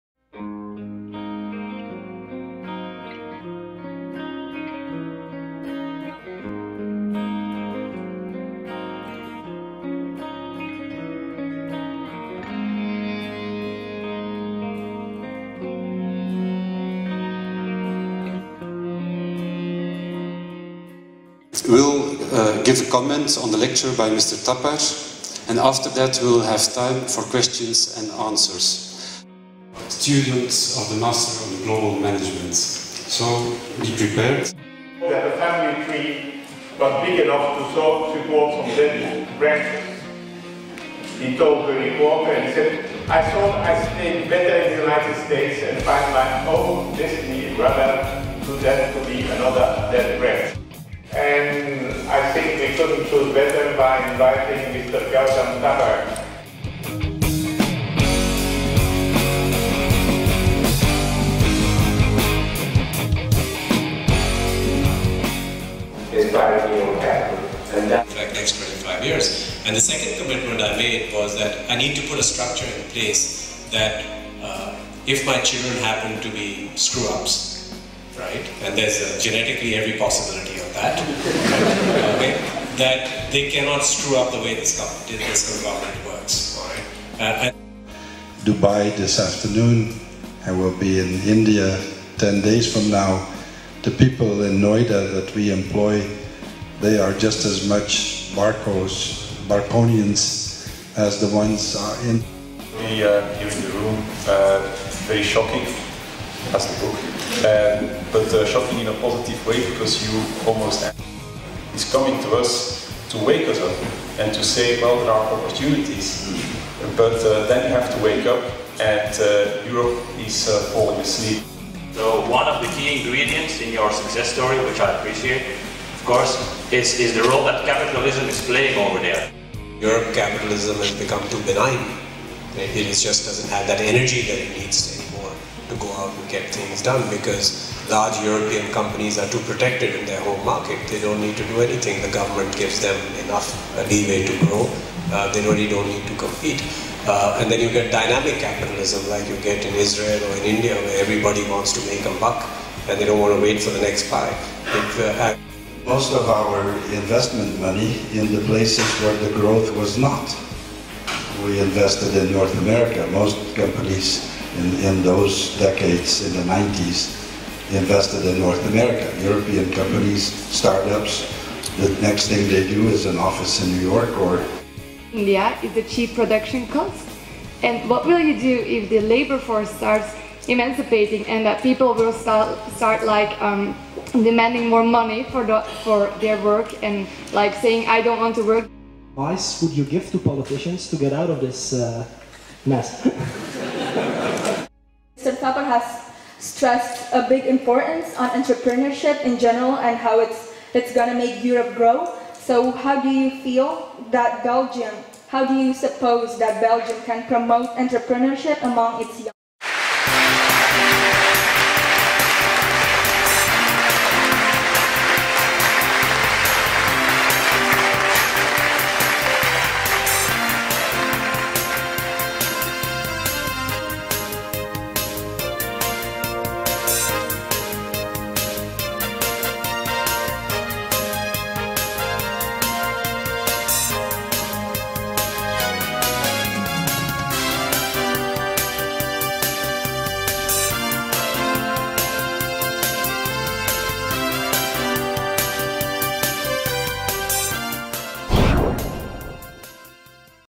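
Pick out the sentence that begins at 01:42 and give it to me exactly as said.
We uh, here in the room, uh, very shocking as the book.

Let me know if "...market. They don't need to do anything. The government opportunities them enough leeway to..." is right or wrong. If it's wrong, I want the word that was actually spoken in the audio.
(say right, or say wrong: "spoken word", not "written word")
wrong: "gives", not "opportunities".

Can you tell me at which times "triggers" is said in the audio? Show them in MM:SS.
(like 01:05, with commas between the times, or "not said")
not said.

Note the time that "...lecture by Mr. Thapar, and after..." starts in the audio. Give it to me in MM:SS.
00:23.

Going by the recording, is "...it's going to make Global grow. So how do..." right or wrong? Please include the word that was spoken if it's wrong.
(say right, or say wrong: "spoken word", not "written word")
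wrong: "Europe", not "Global".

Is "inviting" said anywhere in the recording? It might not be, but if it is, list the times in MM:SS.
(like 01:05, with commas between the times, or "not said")
00:54.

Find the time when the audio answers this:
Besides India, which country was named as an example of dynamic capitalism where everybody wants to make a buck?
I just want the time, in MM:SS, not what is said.
02:29.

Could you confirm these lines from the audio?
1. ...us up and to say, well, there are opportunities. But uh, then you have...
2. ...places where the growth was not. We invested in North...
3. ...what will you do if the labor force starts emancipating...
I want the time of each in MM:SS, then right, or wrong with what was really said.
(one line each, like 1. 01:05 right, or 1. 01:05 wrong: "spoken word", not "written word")
1. 01:53 right
2. 02:38 right
3. 02:57 right.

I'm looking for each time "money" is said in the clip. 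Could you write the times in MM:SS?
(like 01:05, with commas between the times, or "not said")
02:37, 03:04.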